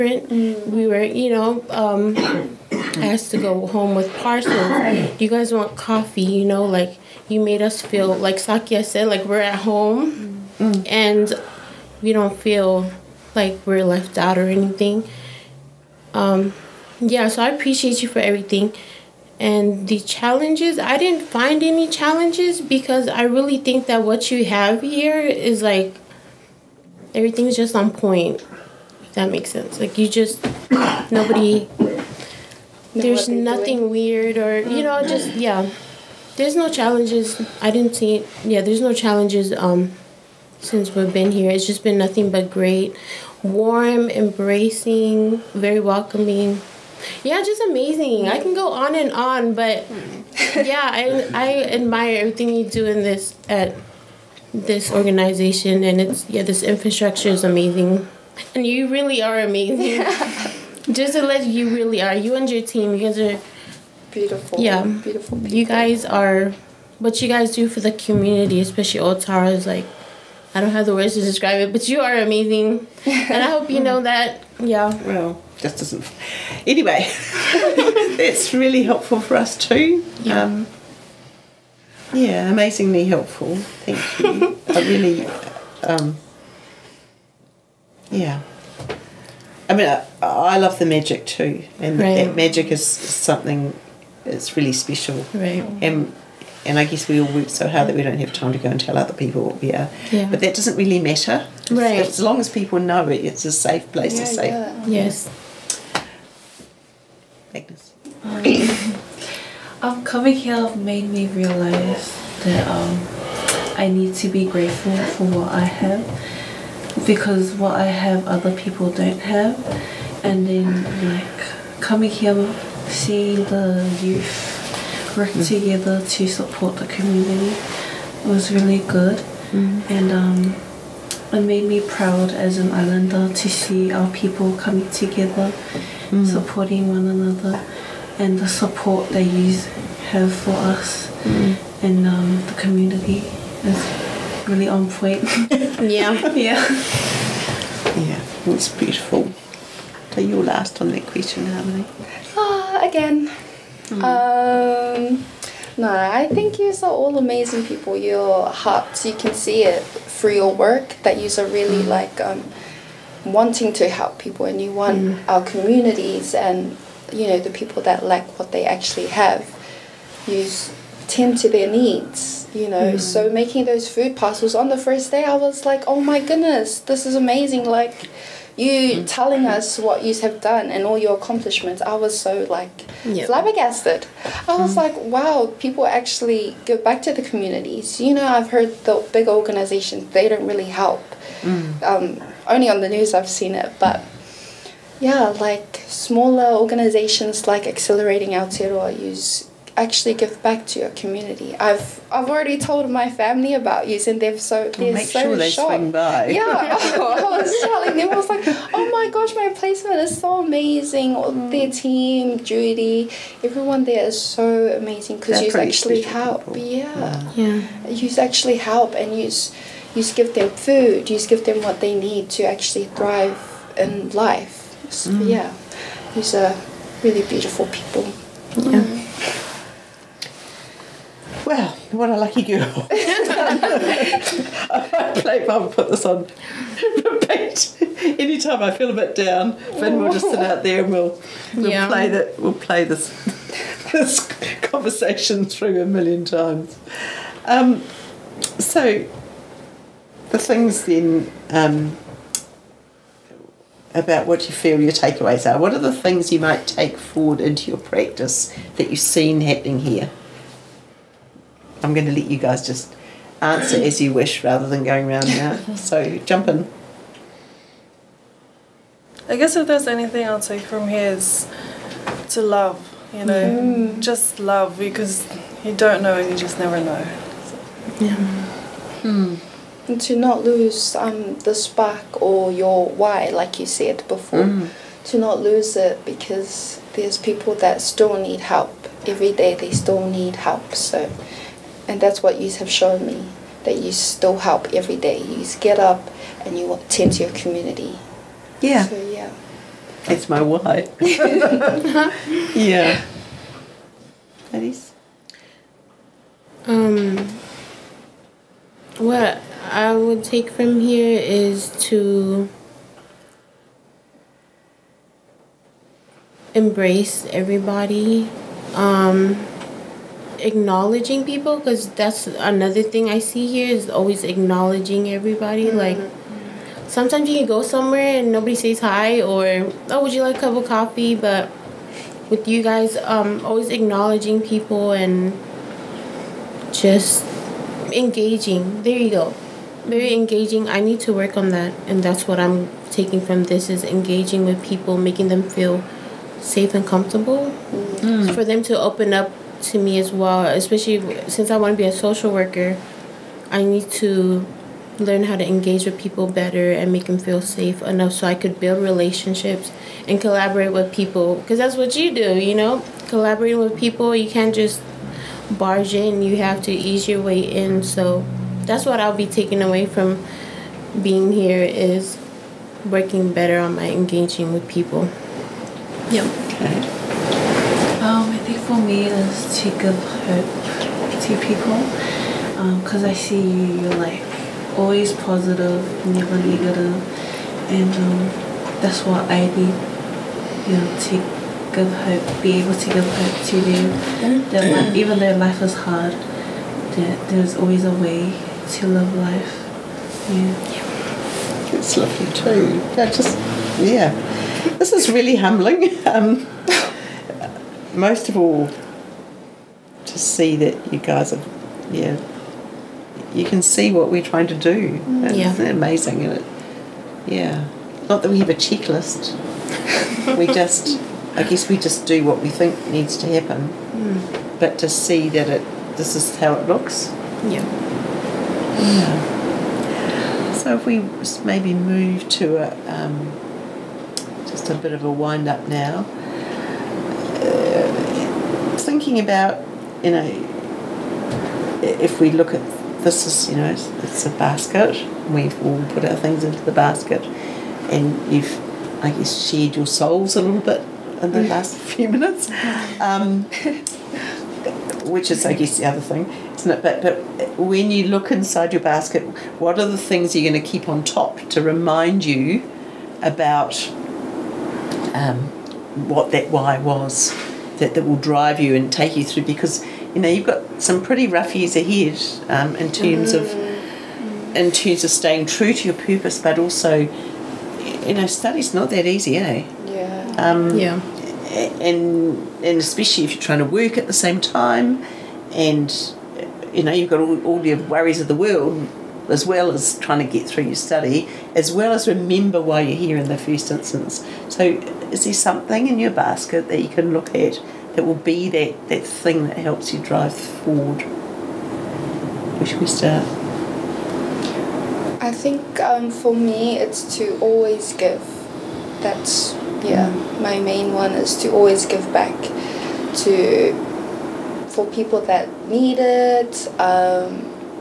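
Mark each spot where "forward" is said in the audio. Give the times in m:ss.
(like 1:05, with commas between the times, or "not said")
4:16, 8:20.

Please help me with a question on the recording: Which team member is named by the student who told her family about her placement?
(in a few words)
Judy.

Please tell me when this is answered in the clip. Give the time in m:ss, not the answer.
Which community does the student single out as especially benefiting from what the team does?
1:09.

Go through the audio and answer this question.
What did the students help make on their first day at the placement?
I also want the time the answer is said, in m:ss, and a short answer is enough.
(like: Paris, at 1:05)
Food parcels, at 2:53.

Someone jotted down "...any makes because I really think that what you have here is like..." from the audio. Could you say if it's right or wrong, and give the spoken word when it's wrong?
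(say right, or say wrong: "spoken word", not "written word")
wrong: "challenges", not "makes".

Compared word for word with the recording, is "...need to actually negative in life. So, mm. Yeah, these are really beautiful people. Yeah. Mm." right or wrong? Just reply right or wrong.
wrong.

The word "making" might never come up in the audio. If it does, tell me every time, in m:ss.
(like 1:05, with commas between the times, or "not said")
2:53, 5:44.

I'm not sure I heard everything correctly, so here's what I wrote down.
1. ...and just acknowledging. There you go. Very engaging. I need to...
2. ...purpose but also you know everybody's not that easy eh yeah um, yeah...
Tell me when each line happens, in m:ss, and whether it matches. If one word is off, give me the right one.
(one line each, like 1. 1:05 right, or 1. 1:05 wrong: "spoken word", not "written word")
1. 5:34 wrong: "engaging", not "acknowledging"
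2. 7:56 wrong: "study", not "everybody".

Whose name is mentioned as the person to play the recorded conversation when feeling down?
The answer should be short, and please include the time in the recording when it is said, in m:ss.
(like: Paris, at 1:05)
Finn, at 3:59.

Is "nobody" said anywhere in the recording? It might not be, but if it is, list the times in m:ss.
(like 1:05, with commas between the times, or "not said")
0:31, 5:28.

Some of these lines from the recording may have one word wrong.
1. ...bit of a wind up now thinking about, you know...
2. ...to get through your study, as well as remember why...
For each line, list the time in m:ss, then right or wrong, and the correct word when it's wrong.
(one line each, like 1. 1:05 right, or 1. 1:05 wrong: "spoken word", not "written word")
1. 7:14 right
2. 8:10 right.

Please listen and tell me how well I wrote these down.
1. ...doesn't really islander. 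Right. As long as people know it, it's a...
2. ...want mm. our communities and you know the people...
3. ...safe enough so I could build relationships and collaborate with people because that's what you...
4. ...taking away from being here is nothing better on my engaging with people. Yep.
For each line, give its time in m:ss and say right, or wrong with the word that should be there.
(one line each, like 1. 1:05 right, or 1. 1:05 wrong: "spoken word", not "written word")
1. 1:40 wrong: "matter", not "islander"
2. 2:44 right
3. 5:57 right
4. 6:09 wrong: "working", not "nothing".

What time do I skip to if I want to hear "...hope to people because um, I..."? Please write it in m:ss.
6:20.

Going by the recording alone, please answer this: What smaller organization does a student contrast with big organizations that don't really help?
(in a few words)
Accelerating Aotearoa.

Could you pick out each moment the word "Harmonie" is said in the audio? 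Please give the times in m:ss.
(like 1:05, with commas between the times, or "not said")
2:31.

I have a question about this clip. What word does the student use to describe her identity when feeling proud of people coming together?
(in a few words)
Islander.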